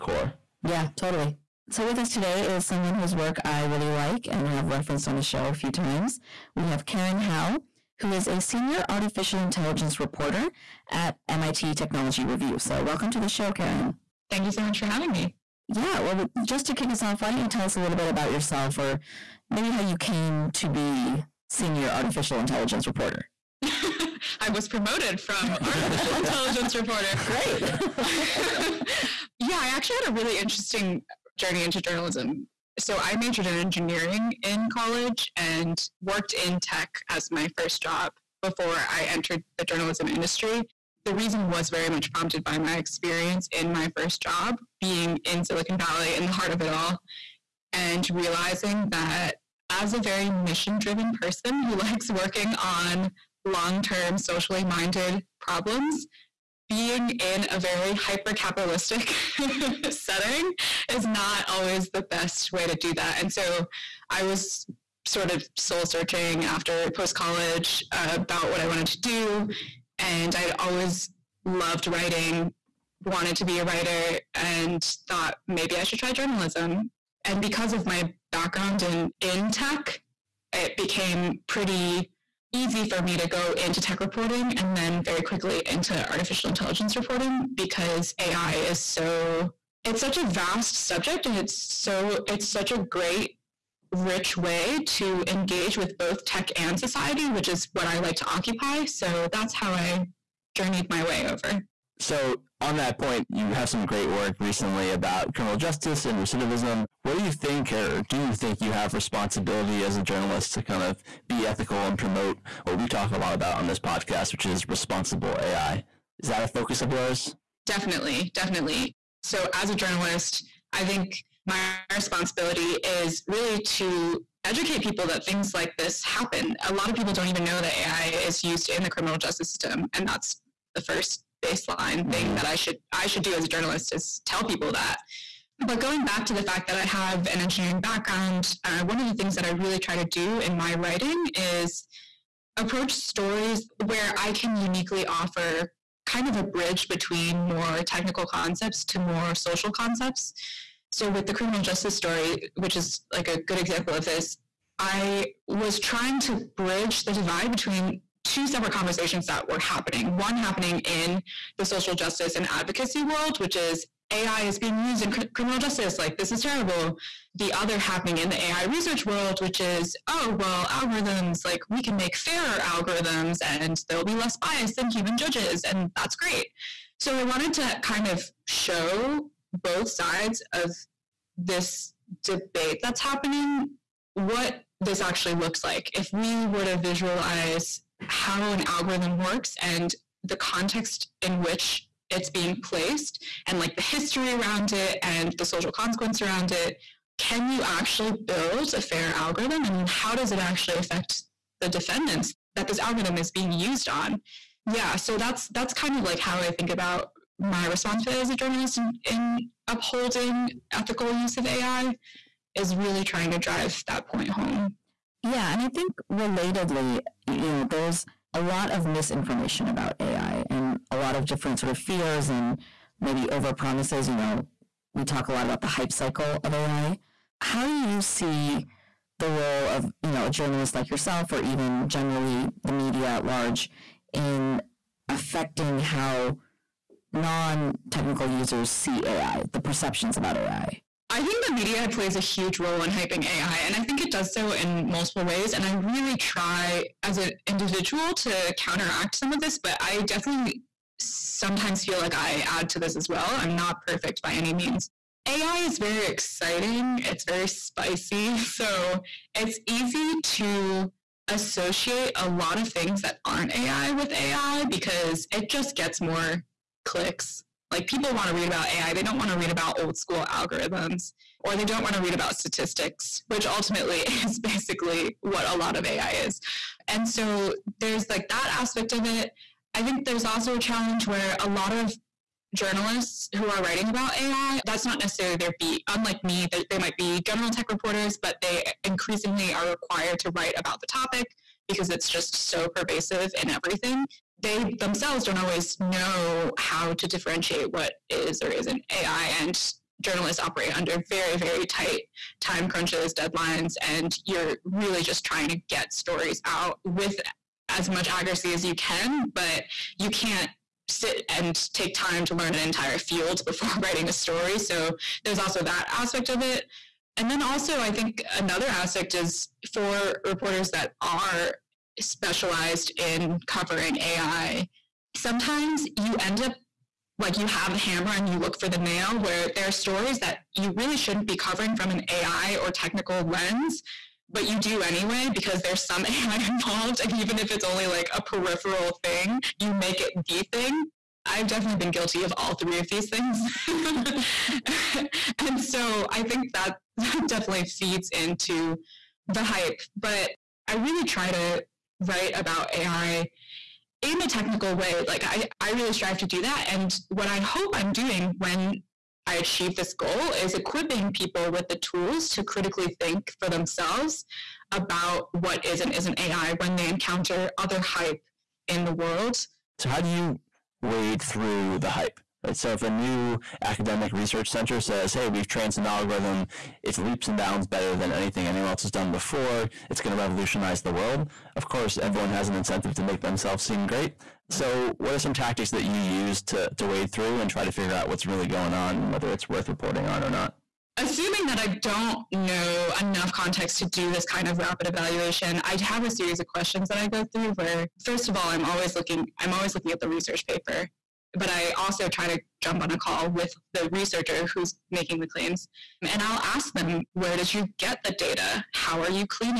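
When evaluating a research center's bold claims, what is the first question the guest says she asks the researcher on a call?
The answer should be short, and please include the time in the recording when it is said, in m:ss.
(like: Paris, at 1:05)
Where did you get the data?, at 6:47.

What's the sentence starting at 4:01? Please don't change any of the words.
I think the media plays a huge role in hyping AI, and I think it does so in multiple ways.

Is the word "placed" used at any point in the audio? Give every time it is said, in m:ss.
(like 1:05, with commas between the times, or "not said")
3:12.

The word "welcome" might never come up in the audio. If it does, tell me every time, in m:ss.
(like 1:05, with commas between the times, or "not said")
0:12.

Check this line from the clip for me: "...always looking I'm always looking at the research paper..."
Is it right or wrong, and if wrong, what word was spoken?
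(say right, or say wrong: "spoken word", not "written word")
right.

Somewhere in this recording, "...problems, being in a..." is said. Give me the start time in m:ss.
0:55.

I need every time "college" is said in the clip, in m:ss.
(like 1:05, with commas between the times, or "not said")
0:34, 1:07.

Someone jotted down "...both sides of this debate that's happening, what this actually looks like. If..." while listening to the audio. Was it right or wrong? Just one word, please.
right.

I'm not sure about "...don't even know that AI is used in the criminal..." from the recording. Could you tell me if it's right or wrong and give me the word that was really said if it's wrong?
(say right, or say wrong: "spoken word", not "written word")
right.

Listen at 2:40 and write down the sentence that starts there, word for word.
One happening in the social justice and advocacy world, which is AI is being used in cr- criminal justice.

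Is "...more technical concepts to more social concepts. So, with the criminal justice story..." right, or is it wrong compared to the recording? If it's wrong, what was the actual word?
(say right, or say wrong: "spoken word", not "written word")
right.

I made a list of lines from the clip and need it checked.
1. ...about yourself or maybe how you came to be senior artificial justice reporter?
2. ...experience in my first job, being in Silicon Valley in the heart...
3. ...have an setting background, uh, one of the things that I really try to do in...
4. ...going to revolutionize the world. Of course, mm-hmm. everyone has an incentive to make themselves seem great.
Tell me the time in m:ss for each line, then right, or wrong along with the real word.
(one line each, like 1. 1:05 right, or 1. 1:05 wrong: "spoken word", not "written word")
1. 0:18 wrong: "intelligence", not "justice"
2. 0:42 right
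3. 2:16 wrong: "engineering", not "setting"
4. 6:19 right.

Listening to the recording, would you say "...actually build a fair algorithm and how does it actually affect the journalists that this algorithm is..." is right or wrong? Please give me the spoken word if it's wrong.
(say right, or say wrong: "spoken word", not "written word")
wrong: "defendants", not "journalists".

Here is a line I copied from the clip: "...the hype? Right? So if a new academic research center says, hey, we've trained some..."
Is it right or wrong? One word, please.
right.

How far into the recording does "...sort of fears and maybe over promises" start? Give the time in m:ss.
3:41.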